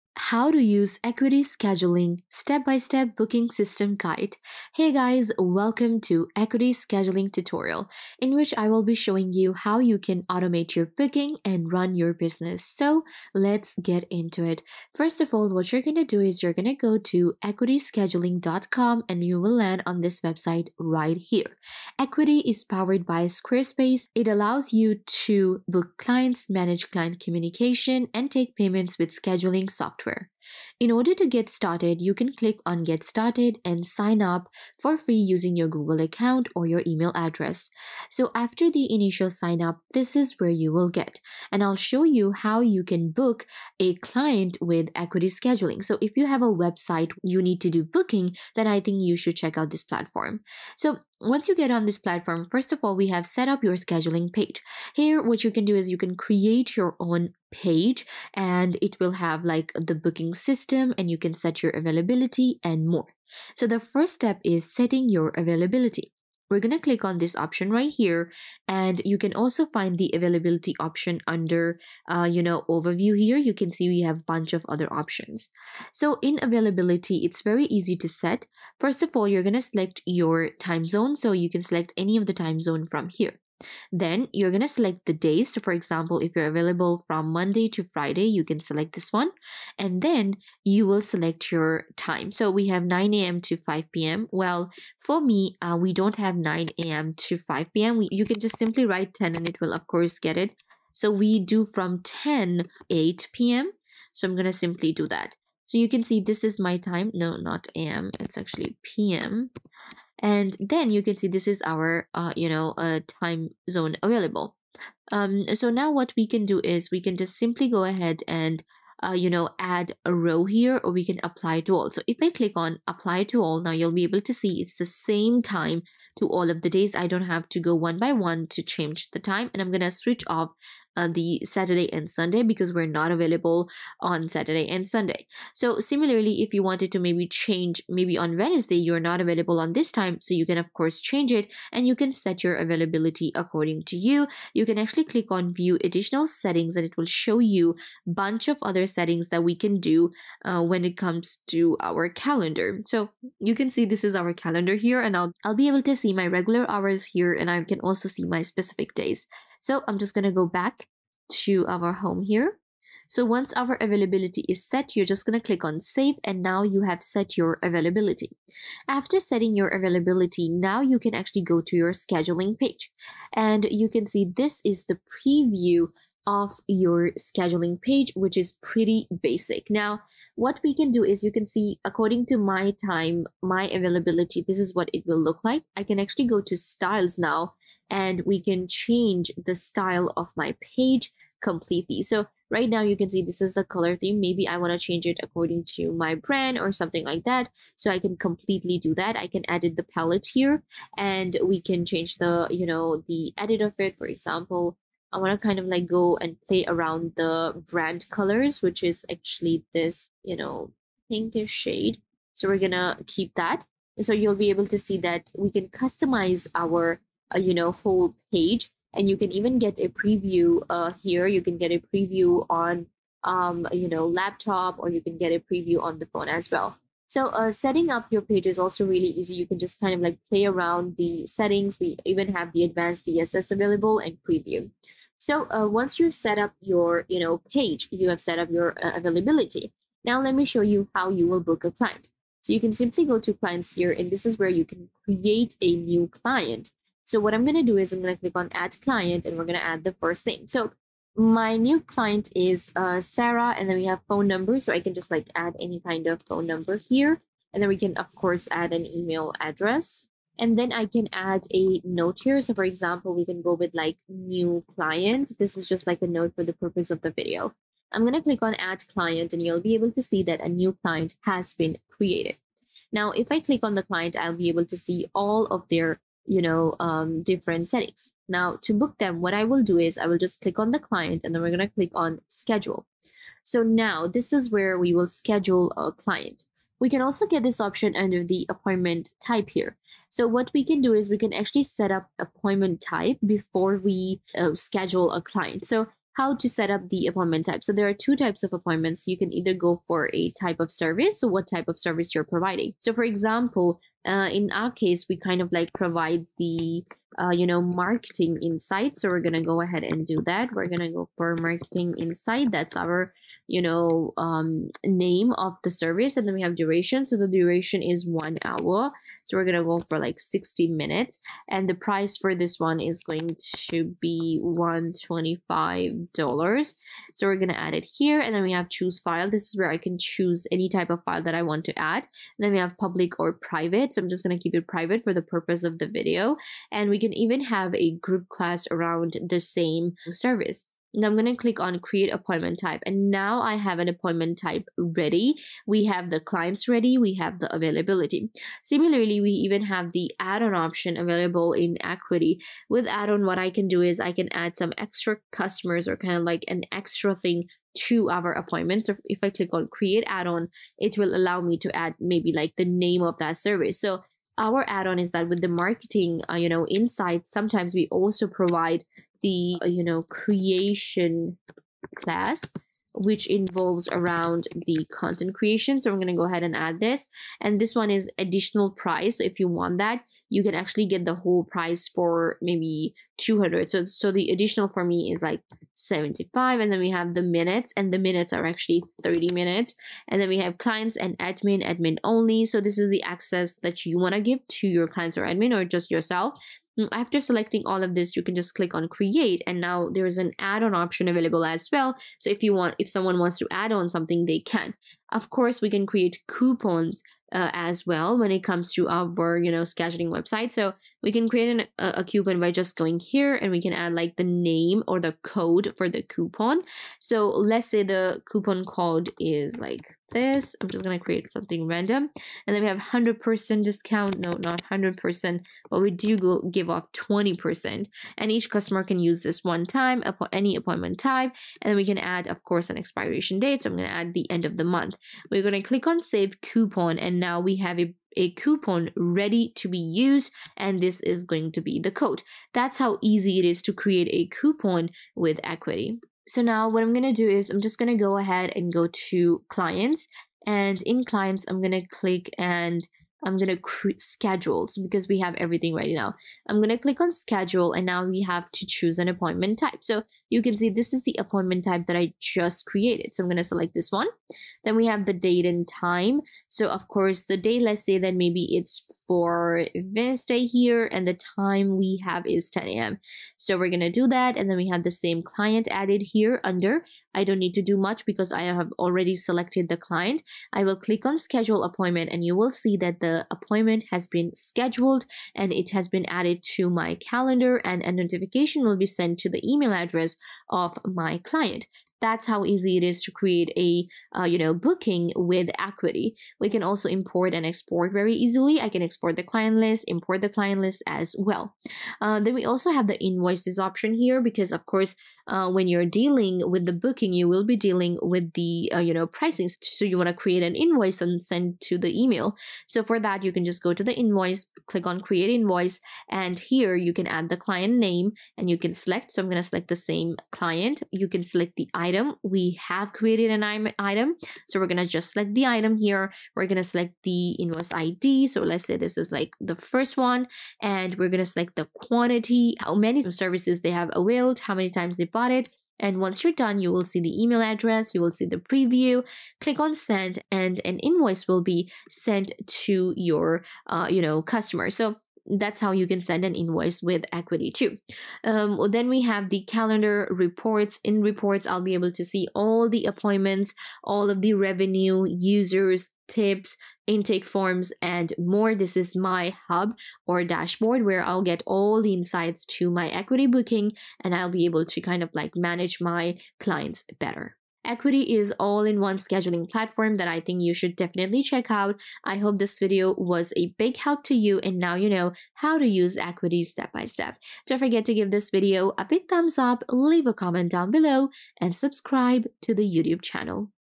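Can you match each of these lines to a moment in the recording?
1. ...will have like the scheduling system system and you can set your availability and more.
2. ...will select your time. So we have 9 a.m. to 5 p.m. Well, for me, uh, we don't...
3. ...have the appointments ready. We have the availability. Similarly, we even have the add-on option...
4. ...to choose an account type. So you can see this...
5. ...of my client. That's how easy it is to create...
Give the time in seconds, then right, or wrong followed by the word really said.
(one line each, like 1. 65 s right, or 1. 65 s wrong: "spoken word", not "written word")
1. 58 s wrong: "booking", not "scheduling"
2. 90 s right
3. 345 s wrong: "clients", not "appointments"
4. 458 s wrong: "appointment", not "account"
5. 490 s right.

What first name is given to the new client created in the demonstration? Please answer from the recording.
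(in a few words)
Sarah.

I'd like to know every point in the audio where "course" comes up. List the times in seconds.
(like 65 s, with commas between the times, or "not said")
99 s, 140 s, 258 s, 405 s, 432 s, 466 s, 504 s.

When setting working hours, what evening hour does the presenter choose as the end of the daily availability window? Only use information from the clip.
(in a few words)
8 p.m.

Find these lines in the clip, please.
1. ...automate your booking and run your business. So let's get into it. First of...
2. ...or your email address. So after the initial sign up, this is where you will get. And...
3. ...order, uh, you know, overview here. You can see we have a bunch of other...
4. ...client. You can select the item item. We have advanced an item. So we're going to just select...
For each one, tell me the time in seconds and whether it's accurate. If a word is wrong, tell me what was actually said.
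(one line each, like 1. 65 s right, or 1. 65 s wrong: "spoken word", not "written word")
1. 10 s right
2. 36 s right
3. 71 s wrong: "under", not "order"
4. 520 s wrong: "created", not "advanced".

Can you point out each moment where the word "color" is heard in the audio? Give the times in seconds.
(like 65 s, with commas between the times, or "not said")
193 s, 208 s.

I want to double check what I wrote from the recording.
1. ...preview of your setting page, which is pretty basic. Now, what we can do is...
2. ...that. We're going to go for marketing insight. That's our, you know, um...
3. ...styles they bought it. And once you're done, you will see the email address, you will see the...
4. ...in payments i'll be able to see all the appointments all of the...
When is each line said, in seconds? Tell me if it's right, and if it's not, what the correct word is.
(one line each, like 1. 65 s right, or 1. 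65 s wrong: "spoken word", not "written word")
1. 175 s wrong: "scheduling", not "setting"
2. 310 s right
3. 534 s wrong: "times", not "styles"
4. 550 s wrong: "reports", not "payments".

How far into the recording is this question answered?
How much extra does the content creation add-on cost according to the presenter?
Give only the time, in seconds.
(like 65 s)
385 s.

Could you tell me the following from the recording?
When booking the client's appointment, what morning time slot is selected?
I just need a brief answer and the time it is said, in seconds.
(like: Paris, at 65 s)
10 a.m., at 472 s.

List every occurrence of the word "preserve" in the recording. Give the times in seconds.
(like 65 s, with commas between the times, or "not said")
not said.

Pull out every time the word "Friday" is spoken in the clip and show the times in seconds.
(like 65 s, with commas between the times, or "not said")
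87 s.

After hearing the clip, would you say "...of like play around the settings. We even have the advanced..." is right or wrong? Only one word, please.
right.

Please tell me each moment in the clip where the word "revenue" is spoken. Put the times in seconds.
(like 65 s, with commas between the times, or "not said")
554 s.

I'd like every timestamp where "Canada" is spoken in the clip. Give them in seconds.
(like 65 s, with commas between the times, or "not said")
not said.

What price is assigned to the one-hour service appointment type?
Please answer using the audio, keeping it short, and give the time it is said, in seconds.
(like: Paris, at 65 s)
$125, at 324 s.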